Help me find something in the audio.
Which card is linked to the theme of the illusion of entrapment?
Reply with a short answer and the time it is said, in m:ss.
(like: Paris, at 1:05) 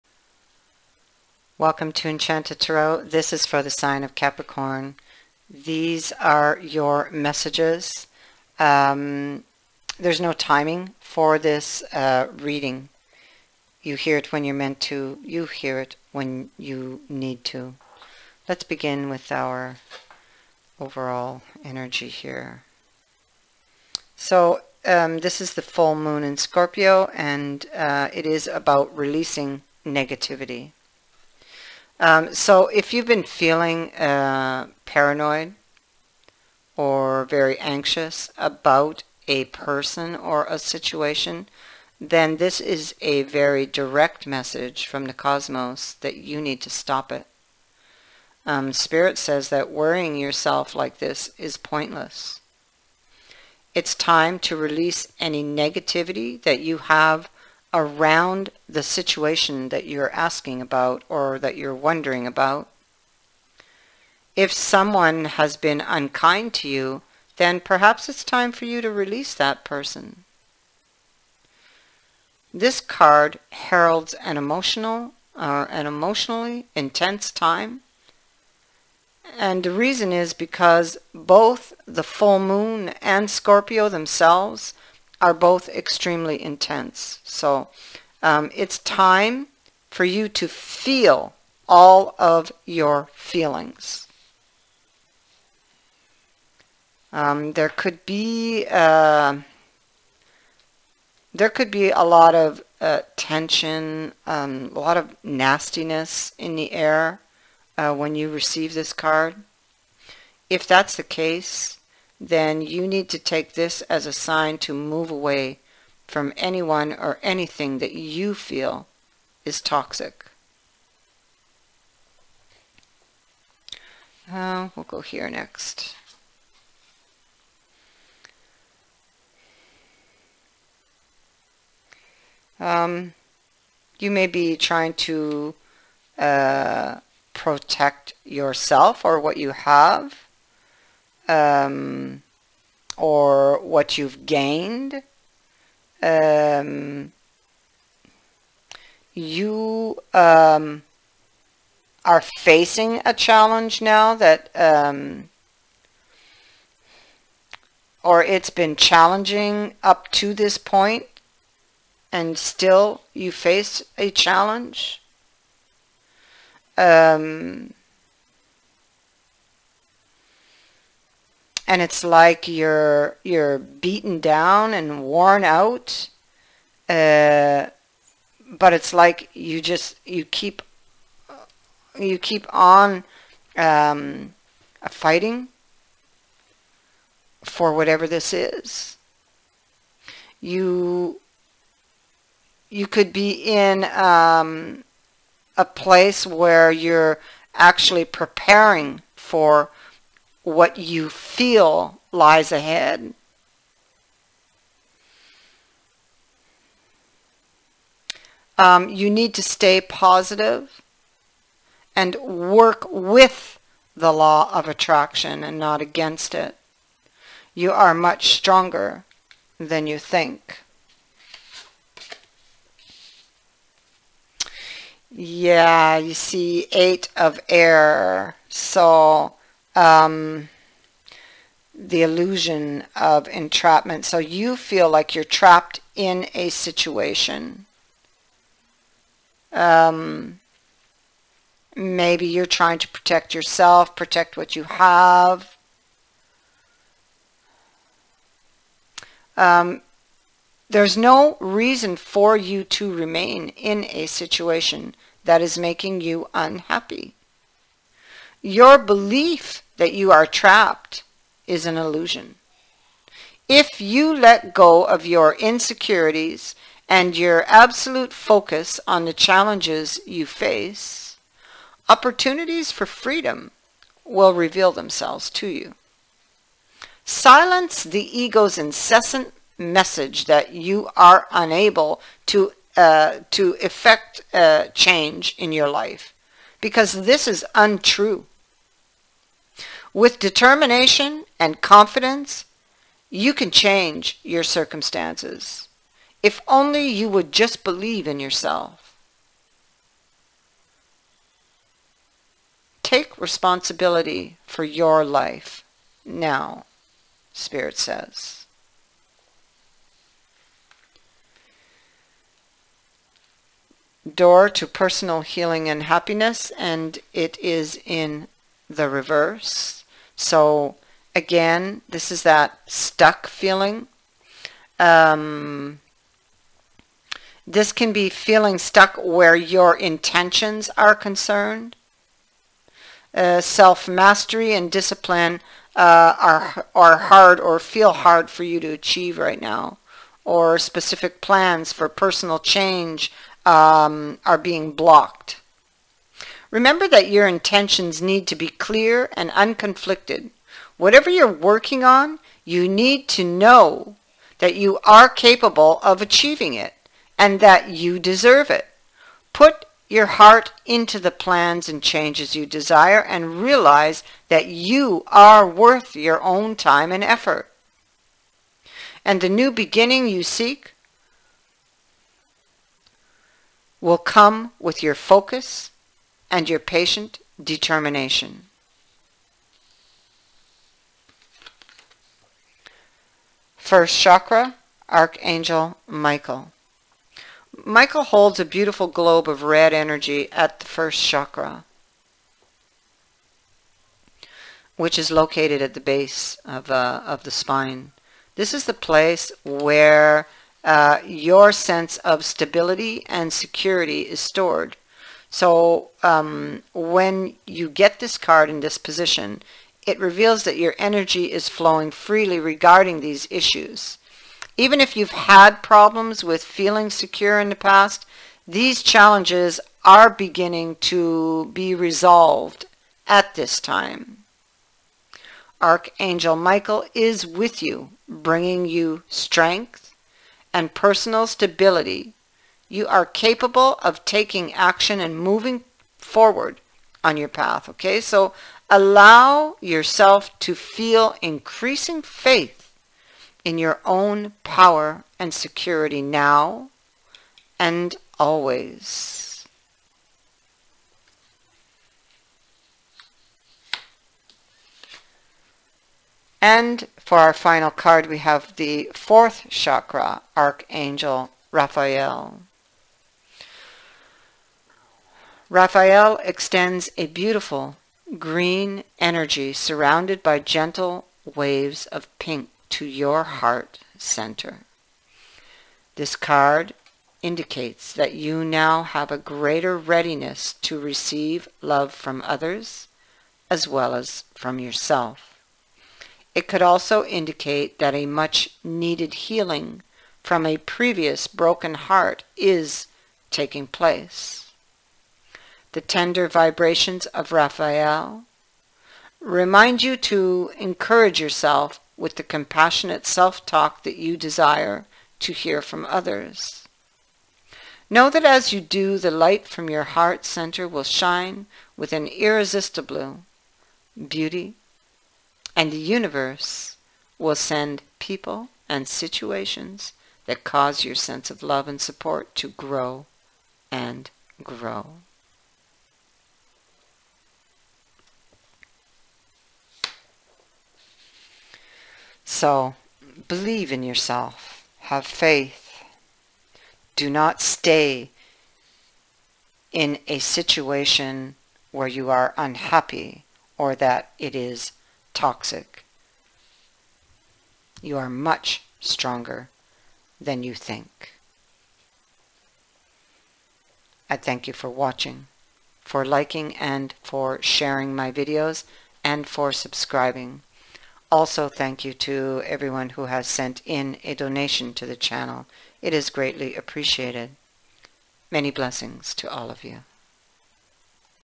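Eight of Air, at 3:46.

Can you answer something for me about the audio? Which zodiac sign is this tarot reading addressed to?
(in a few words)
Capricorn.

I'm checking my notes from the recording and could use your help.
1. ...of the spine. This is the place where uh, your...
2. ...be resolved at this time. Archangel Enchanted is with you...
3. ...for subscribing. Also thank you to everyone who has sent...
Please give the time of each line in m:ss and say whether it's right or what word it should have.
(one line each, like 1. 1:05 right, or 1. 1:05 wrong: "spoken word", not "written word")
1. 6:37 right
2. 7:01 wrong: "Michael", not "Enchanted"
3. 9:19 right.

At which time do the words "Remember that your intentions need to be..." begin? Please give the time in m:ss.
5:46.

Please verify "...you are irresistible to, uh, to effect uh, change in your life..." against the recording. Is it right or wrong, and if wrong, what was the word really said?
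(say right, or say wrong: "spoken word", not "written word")
wrong: "unable", not "irresistible".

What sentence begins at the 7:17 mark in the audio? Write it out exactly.
Okay, so allow yourself to feel increasing faith in your own power and security now and always.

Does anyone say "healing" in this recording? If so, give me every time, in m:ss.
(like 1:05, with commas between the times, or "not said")
5:15, 8:09.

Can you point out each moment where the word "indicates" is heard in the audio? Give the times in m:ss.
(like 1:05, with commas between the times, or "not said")
7:57, 8:07.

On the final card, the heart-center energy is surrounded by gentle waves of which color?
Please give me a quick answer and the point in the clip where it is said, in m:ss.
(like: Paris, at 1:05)
Pink, at 7:52.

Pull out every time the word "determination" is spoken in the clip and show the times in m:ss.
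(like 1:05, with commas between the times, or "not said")
4:50, 6:17.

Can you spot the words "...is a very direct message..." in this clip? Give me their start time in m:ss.
0:42.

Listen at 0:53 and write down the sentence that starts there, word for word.
It's time to release any negativity that you have around the situation that you're asking about or that you're wondering about.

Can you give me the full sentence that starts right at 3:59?
Um, maybe you're trying to protect yourself, protect what you have.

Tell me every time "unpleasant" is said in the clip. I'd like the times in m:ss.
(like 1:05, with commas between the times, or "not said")
not said.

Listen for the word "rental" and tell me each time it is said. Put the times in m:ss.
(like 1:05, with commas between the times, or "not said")
not said.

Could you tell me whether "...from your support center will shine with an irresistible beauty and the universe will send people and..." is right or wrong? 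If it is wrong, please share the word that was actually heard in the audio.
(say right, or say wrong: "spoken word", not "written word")
wrong: "heart", not "support".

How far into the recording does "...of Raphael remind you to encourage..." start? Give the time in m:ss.
8:17.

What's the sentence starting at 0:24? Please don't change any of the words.
So um, this is the full moon in Scorpio, and uh, it is about releasing negativity.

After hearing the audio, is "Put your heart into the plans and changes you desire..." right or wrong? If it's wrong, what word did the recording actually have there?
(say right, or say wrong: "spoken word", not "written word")
right.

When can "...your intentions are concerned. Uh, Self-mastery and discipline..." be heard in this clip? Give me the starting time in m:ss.
5:29.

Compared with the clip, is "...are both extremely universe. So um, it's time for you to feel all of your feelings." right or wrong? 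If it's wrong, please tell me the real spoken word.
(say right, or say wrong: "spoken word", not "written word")
wrong: "intense", not "universe".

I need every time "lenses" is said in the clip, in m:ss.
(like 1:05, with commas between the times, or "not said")
not said.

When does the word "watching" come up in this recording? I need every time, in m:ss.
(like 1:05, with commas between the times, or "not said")
9:14.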